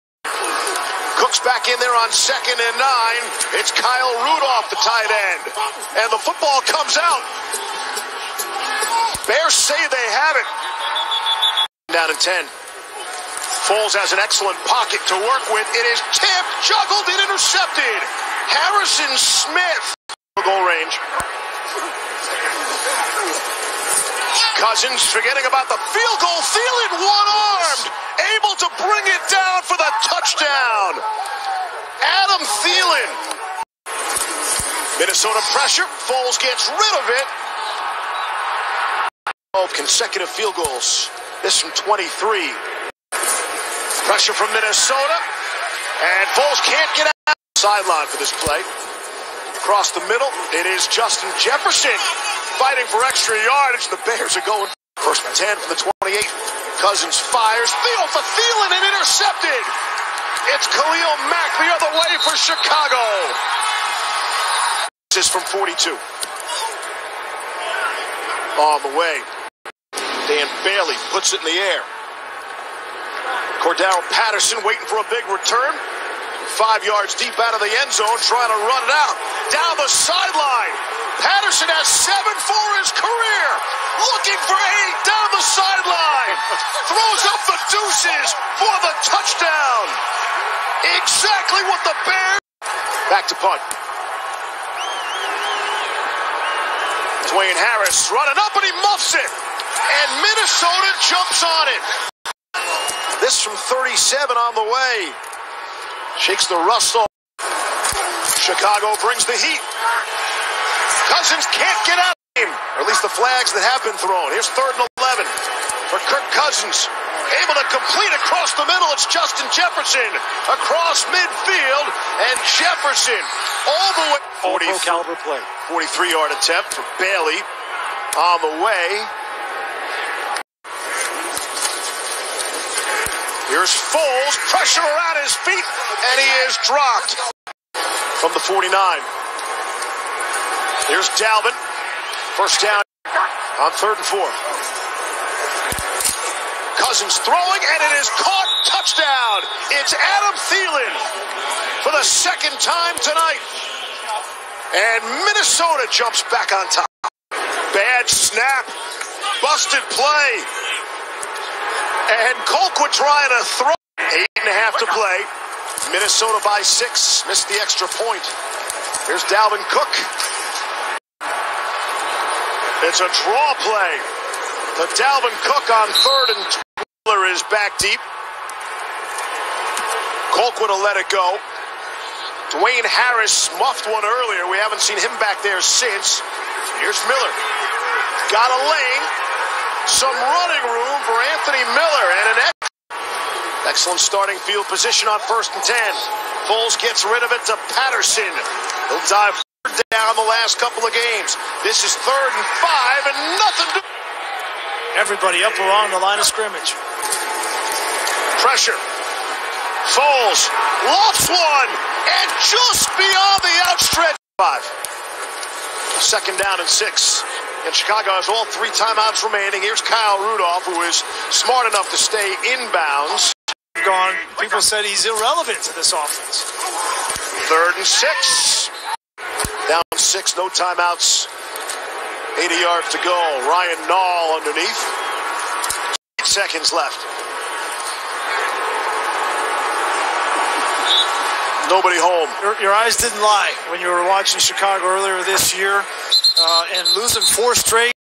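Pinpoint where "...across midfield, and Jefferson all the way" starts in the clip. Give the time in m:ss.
2:00.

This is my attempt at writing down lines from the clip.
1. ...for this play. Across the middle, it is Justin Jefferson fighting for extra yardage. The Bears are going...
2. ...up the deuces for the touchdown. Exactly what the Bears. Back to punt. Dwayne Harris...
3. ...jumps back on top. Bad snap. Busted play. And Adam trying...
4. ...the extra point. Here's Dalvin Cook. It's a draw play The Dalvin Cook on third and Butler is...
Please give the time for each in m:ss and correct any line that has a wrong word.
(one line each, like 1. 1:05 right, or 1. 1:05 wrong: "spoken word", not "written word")
1. 0:48 right
2. 1:27 right
3. 2:35 wrong: "Colquitt", not "Adam"
4. 2:47 right.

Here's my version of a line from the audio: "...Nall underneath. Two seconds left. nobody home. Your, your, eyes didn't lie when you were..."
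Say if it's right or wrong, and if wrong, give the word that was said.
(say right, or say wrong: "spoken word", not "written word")
wrong: "Eight", not "Two".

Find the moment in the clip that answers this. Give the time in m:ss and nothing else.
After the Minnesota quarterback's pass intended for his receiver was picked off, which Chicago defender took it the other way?
1:00.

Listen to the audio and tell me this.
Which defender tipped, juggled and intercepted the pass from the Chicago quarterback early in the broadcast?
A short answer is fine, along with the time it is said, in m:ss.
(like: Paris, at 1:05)
Harrison Smith, at 0:18.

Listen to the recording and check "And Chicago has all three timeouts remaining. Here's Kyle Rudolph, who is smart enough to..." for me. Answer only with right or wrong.
right.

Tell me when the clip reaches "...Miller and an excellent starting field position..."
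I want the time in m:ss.
3:11.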